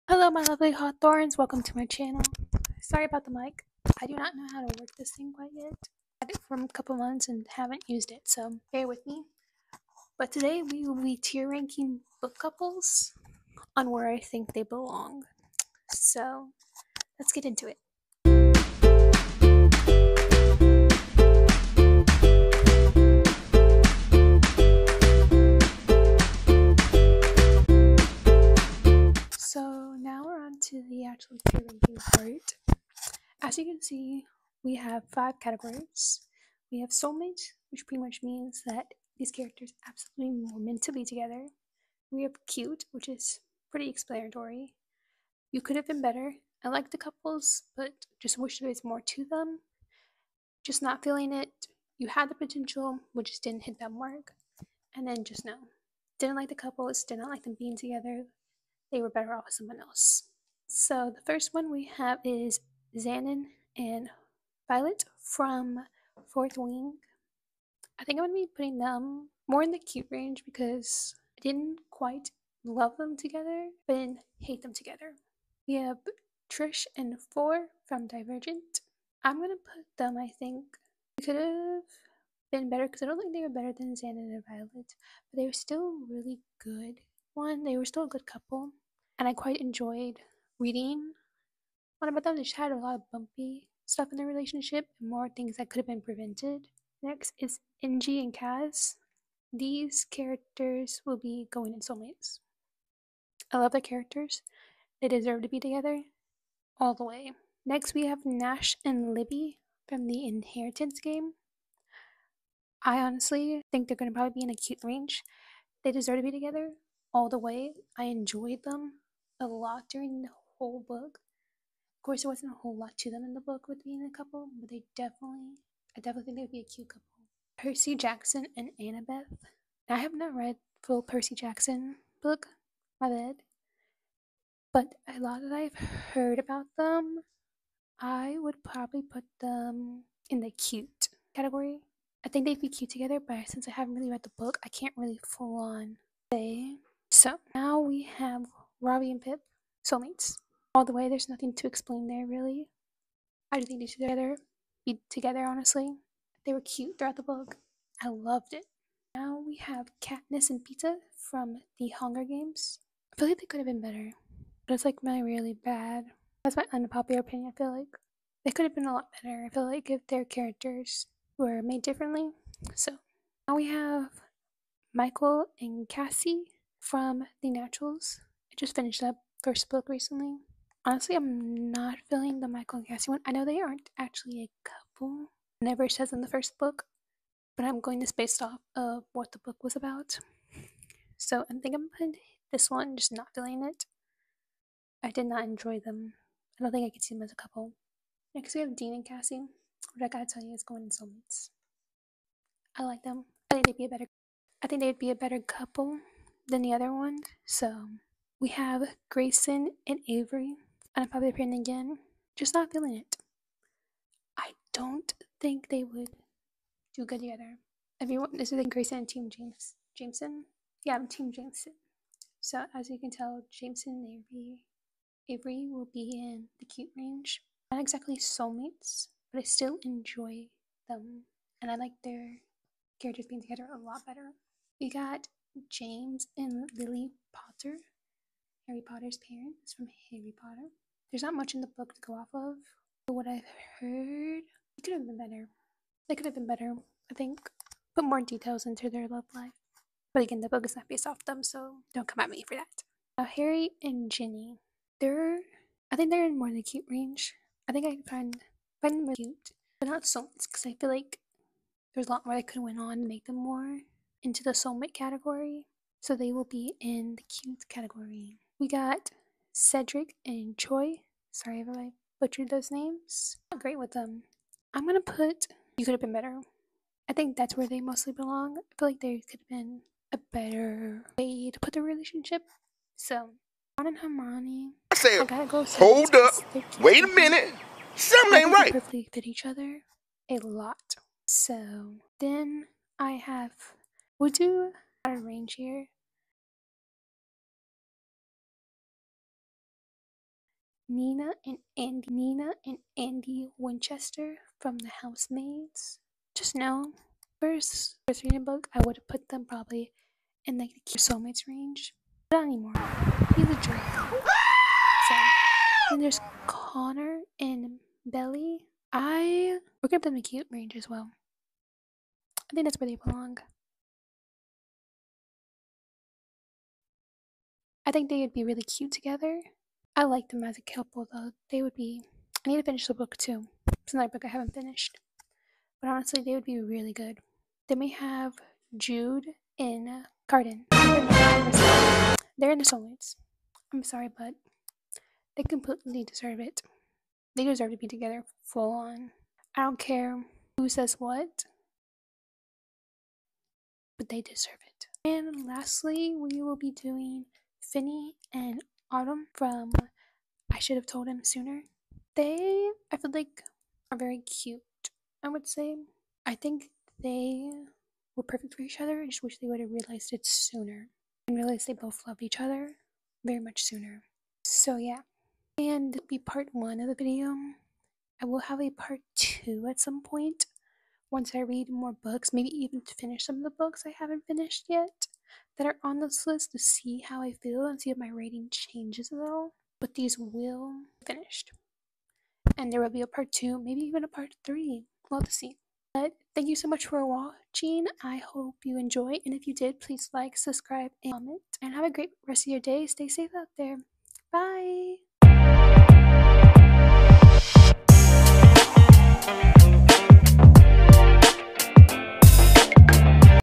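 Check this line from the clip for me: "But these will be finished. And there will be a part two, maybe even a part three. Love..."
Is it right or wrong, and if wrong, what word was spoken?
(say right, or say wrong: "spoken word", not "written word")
right.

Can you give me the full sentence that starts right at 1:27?
One, they were still a good couple, and I quite enjoyed reading what about them.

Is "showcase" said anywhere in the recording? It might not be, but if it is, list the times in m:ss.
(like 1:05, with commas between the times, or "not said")
not said.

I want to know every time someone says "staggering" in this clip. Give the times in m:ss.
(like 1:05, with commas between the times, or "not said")
not said.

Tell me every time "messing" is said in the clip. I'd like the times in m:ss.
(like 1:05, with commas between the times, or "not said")
not said.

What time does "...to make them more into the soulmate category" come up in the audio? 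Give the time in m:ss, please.
4:23.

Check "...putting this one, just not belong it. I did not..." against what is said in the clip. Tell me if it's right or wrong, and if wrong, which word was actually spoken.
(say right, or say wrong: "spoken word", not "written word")
wrong: "feeling", not "belong".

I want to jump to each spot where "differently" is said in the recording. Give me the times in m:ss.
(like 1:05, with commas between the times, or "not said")
2:51.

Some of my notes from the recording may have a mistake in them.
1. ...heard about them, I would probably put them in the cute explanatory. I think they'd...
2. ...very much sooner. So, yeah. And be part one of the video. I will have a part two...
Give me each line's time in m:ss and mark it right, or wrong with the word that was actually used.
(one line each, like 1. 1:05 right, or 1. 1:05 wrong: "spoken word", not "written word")
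1. 2:16 wrong: "category", not "explanatory"
2. 6:13 right.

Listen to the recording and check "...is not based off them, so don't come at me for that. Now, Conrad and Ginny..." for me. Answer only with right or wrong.
wrong.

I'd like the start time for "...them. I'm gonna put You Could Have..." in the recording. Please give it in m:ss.
4:33.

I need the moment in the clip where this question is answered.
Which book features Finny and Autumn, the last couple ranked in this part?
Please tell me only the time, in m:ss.
6:00.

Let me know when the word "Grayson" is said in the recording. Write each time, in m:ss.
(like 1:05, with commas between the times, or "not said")
3:29, 3:38.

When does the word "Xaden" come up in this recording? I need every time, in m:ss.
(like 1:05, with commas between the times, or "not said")
1:02, 1:23.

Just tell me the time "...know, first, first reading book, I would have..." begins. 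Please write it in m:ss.
5:06.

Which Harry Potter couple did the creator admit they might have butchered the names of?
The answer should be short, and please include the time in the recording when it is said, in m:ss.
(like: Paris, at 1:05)
Cedric and Cho, at 4:29.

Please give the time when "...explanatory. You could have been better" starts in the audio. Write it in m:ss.
0:43.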